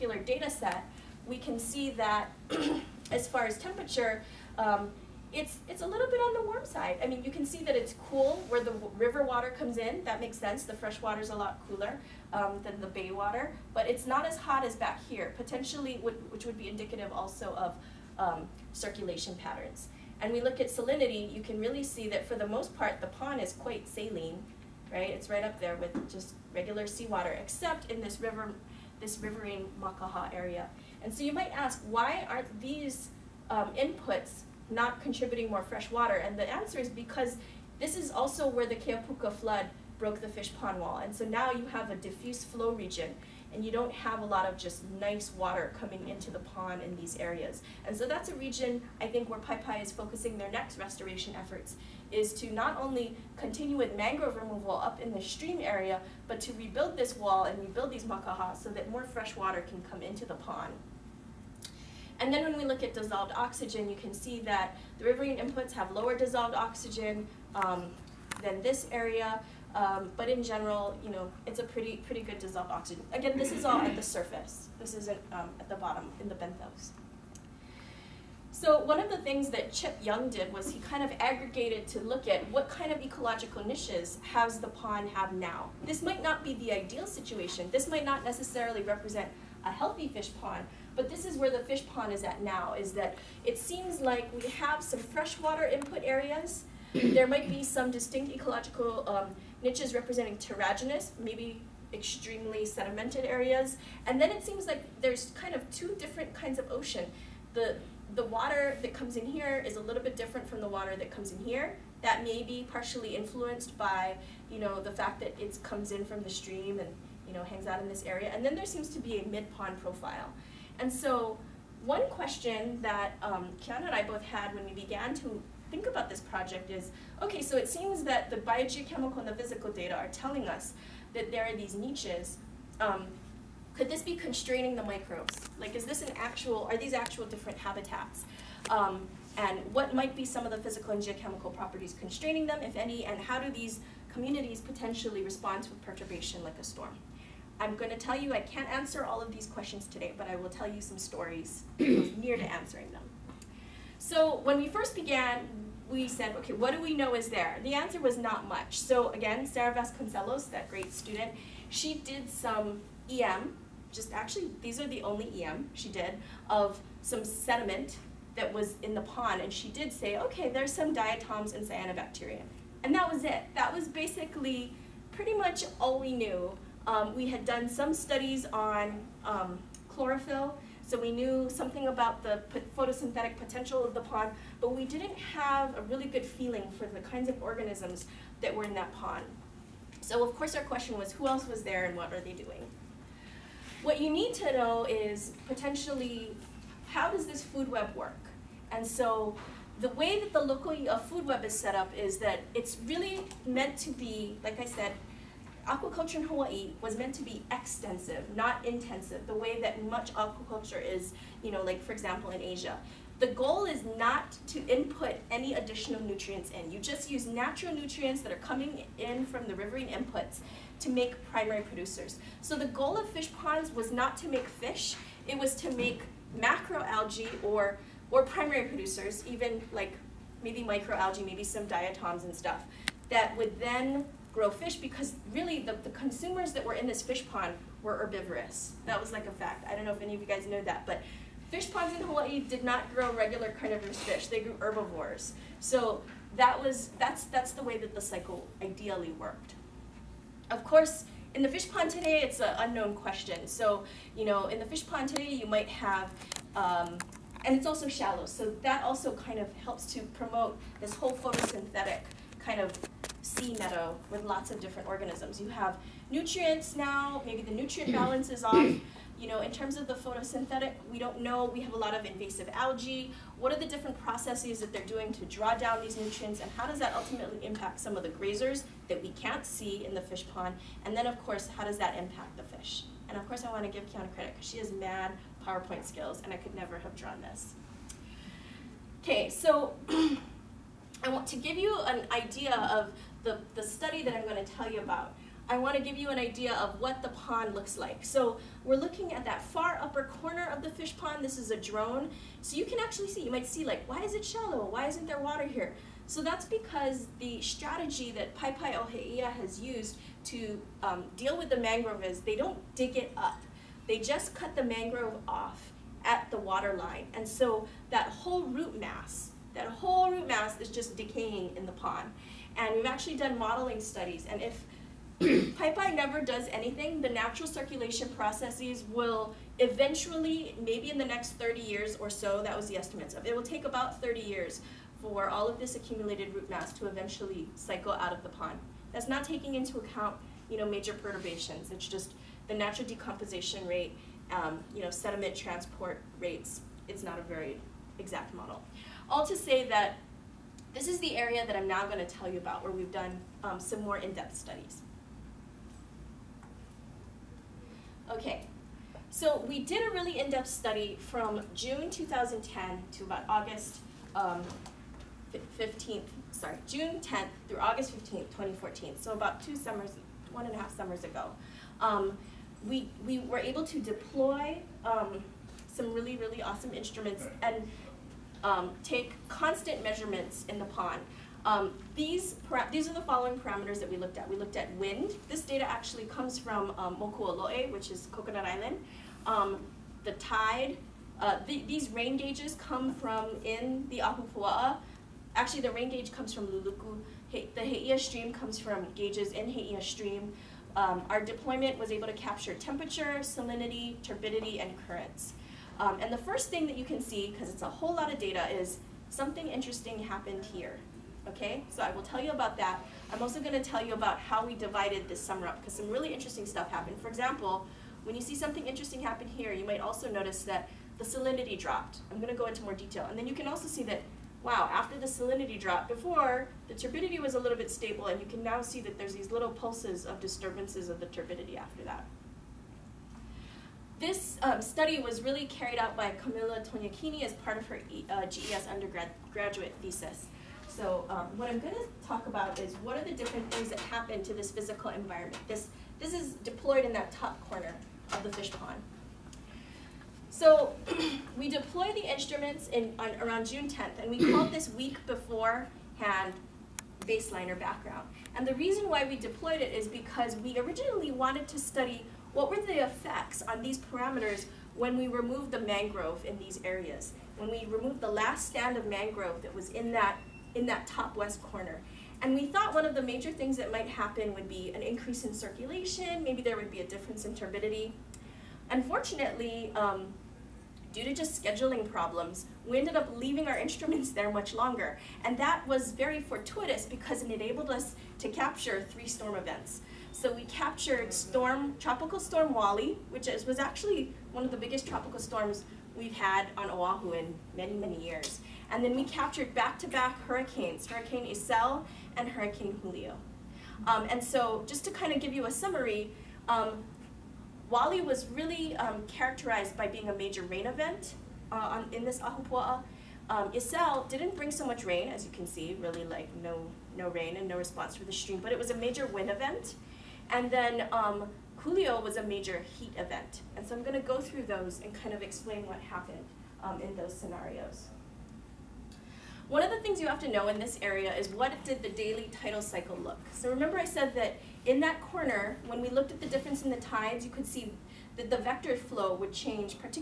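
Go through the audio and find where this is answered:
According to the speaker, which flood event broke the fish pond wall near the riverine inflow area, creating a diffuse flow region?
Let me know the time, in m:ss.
0:38.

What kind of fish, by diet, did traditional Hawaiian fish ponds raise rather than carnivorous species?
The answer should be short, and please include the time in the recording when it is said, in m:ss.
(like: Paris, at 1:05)
Herbivores, at 4:04.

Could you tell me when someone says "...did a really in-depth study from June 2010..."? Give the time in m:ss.
5:59.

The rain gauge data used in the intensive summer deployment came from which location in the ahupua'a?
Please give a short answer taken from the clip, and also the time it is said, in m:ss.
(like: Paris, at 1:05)
Luluku, at 6:36.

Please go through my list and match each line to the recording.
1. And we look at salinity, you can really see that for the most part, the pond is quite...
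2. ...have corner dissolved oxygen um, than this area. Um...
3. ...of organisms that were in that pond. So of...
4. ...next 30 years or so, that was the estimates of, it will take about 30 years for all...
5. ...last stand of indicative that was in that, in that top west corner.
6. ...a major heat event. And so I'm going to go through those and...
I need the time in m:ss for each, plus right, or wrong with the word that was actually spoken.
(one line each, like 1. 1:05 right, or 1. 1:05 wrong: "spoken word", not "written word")
1. 0:20 right
2. 1:05 wrong: "lower", not "corner"
3. 3:07 right
4. 5:31 right
5. 7:48 wrong: "mangrove", not "indicative"
6. 8:42 right.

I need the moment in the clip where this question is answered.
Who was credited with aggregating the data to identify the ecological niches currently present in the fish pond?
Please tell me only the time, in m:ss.
1:19.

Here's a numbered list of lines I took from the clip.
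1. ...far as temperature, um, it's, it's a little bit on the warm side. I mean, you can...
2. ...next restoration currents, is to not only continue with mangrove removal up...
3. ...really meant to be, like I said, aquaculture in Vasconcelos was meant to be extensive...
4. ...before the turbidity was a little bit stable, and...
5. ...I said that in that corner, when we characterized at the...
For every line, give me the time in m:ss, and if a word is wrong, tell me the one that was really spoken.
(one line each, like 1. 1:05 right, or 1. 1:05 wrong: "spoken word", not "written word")
1. 0:03 right
2. 0:50 wrong: "efforts", not "currents"
3. 3:22 wrong: "Hawaii", not "Vasconcelos"
4. 7:05 right
5. 8:53 wrong: "looked", not "characterized".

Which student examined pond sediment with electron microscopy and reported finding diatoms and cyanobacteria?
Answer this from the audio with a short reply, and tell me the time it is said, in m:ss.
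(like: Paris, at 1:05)
Sarah Vasconcelos, at 2:39.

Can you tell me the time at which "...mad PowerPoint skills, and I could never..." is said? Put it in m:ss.
4:44.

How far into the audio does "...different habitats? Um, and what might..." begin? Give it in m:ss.
2:17.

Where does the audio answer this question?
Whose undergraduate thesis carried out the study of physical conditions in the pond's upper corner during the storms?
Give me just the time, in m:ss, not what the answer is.
7:16.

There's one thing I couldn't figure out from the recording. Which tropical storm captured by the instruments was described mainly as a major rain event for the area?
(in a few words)
Tropical Storm Wali.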